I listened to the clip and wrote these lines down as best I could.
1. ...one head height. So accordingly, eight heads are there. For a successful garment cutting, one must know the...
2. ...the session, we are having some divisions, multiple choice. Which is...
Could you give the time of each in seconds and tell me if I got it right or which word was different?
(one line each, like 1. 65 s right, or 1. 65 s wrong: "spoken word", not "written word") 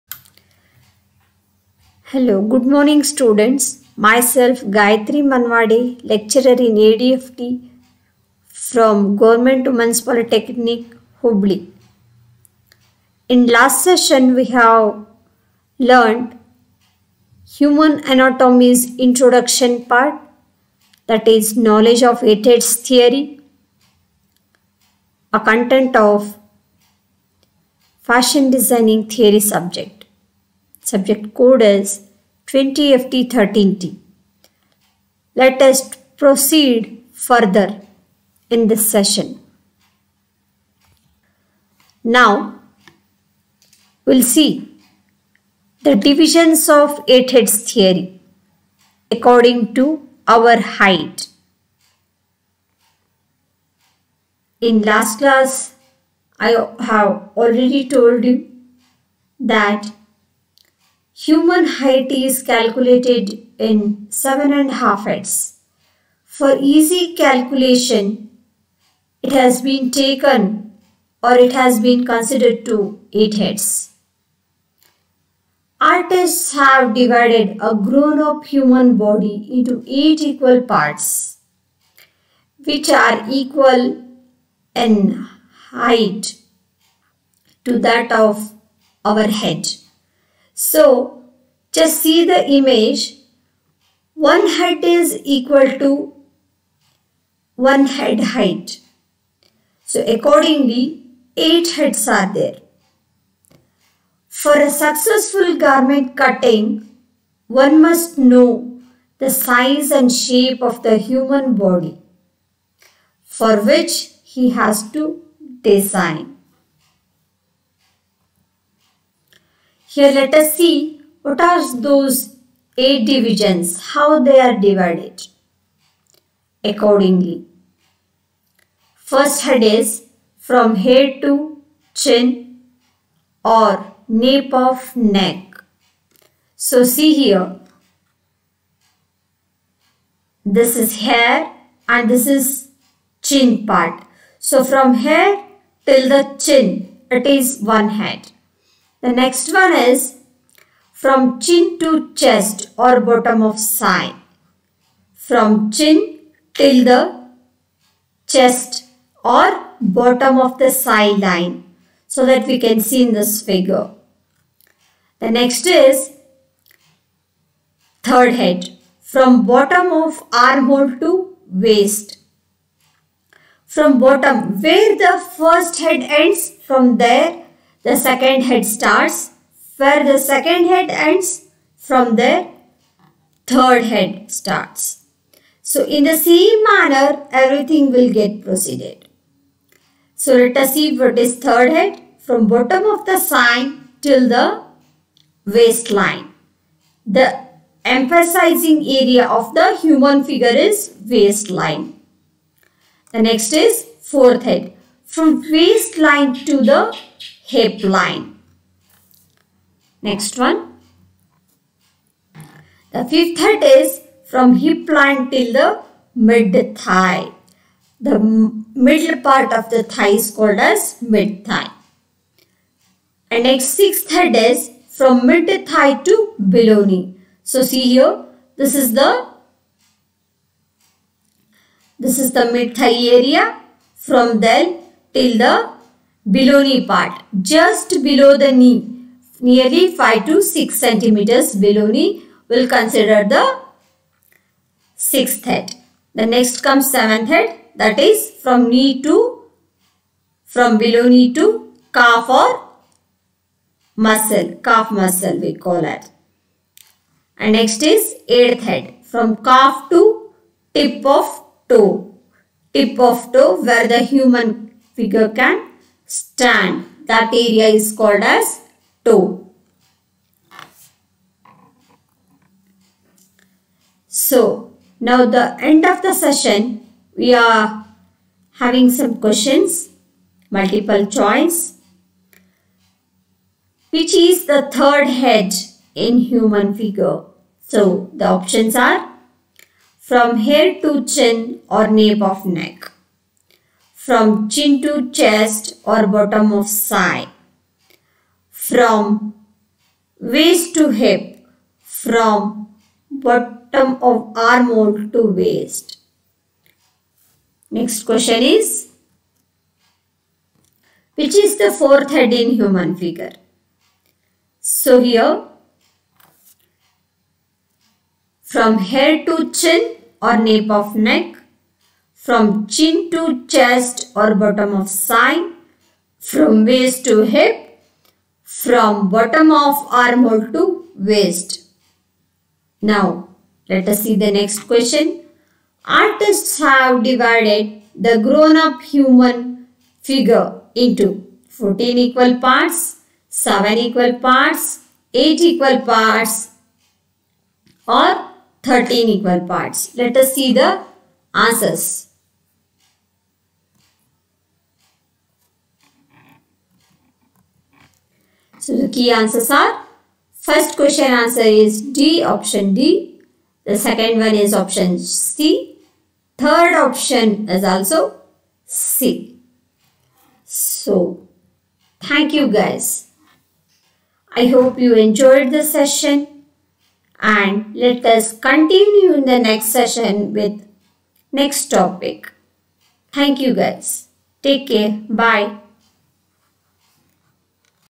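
1. 97 s right
2. 276 s wrong: "questions", not "divisions".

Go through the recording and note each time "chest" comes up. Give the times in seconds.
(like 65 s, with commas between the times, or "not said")
152 s, 158 s, 295 s, 323 s.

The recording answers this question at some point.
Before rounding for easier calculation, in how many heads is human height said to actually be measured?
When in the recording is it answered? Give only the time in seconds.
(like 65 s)
64 s.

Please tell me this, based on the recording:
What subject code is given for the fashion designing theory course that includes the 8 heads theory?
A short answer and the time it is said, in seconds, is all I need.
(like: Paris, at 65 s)
20FT13T, at 32 s.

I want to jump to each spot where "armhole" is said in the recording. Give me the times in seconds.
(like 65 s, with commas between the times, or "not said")
170 s, 304 s, 330 s.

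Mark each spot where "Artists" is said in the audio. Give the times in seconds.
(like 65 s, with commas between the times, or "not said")
75 s, 335 s.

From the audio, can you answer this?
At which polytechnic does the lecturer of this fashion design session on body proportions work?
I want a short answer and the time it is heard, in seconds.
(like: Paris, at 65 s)
Government Women's Polytechnic, Hubli, at 9 s.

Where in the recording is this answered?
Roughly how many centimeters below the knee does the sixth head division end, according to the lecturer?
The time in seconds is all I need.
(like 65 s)
239 s.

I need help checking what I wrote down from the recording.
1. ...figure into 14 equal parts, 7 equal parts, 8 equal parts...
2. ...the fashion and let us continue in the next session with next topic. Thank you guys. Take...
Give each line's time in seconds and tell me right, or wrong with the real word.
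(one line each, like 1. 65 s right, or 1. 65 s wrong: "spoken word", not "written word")
1. 340 s right
2. 375 s wrong: "session", not "fashion".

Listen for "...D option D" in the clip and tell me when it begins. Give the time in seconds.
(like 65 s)
361 s.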